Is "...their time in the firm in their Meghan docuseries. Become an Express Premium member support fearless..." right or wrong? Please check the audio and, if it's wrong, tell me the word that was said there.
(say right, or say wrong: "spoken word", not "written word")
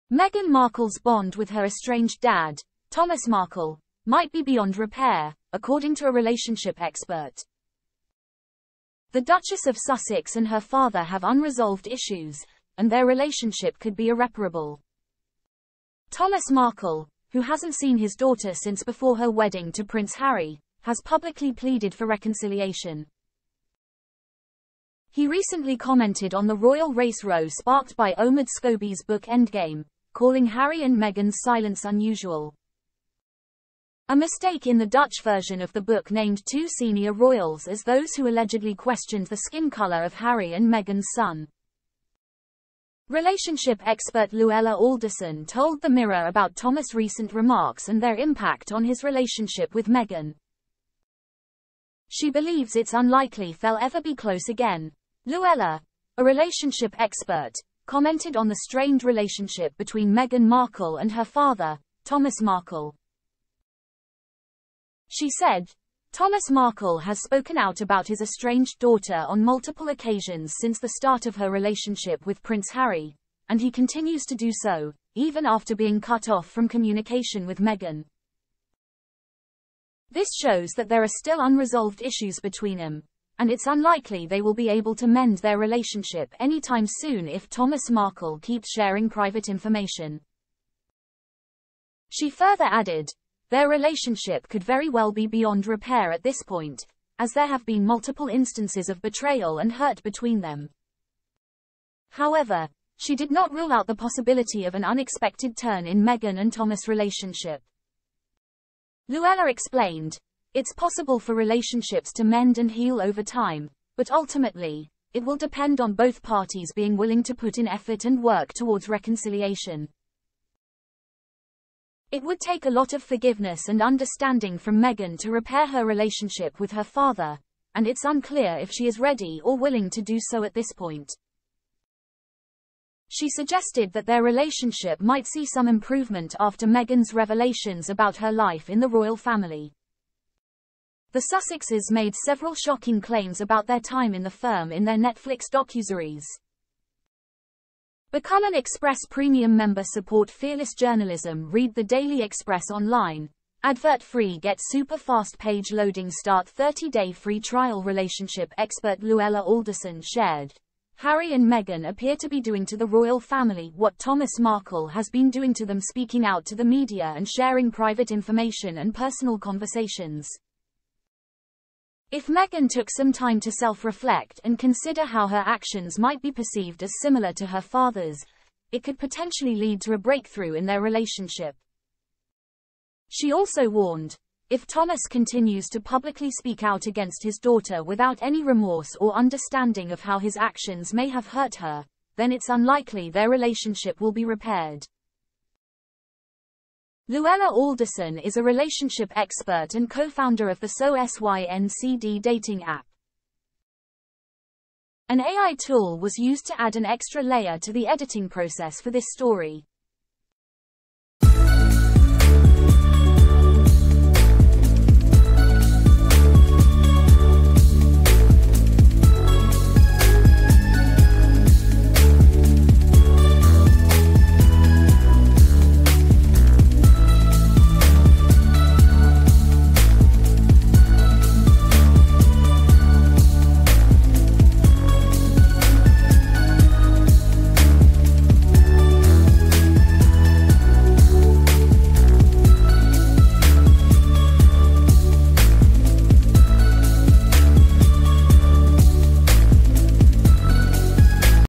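wrong: "Netflix", not "Meghan".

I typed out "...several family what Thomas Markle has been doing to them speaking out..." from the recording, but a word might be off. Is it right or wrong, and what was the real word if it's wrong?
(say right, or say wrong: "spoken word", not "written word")
wrong: "royal", not "several".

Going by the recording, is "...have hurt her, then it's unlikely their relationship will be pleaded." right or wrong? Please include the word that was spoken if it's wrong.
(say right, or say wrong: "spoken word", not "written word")
wrong: "repaired", not "pleaded".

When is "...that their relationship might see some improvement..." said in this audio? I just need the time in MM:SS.
02:13.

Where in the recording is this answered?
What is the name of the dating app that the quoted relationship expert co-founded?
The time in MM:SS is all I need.
03:20.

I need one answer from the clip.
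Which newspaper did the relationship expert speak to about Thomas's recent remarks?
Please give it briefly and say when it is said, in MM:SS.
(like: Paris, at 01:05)
The Mirror, at 00:45.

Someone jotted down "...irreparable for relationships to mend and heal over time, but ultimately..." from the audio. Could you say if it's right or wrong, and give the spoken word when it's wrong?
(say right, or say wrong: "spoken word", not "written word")
wrong: "possible", not "irreparable".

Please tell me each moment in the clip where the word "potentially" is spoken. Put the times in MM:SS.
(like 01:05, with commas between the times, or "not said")
02:58.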